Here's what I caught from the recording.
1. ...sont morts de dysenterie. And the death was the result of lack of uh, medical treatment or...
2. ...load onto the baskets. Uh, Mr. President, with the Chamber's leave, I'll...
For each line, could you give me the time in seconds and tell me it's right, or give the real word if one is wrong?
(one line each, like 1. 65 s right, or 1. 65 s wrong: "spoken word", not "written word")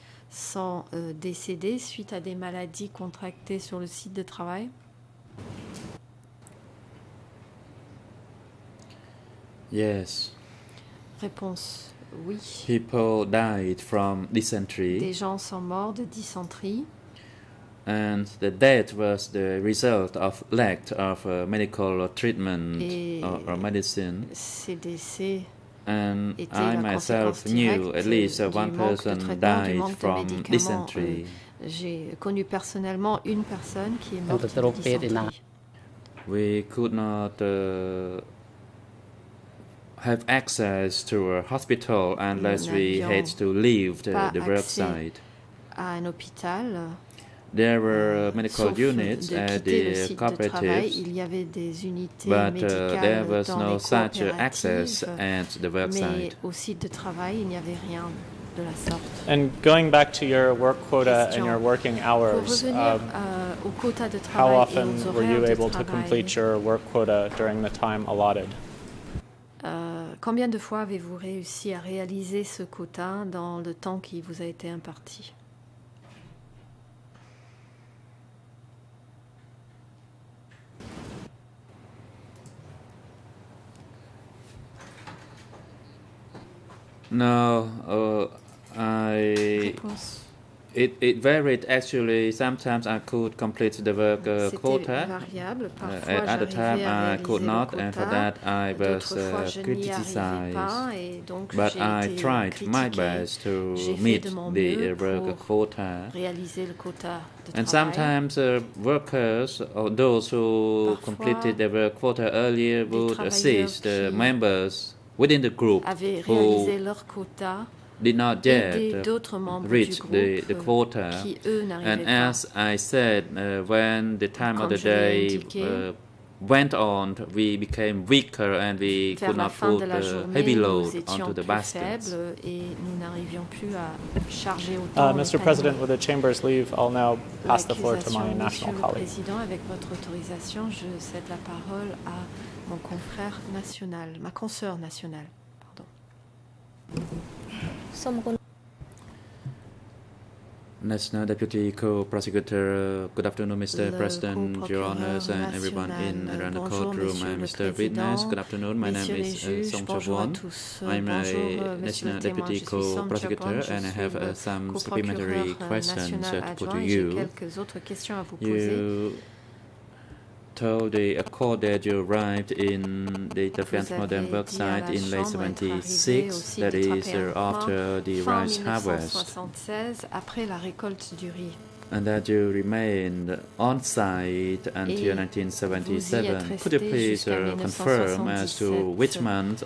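1. 15 s right
2. 130 s right.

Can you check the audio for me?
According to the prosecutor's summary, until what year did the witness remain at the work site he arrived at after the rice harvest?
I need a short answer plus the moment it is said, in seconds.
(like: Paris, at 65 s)
1977, at 185 s.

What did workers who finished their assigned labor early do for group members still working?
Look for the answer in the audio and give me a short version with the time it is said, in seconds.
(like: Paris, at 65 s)
assist members, at 113 s.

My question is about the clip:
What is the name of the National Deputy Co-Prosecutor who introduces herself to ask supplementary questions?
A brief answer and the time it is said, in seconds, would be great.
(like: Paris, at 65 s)
Song Chawon, at 159 s.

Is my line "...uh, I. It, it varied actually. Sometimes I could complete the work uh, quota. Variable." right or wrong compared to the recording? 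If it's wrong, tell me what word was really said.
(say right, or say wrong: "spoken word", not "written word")
right.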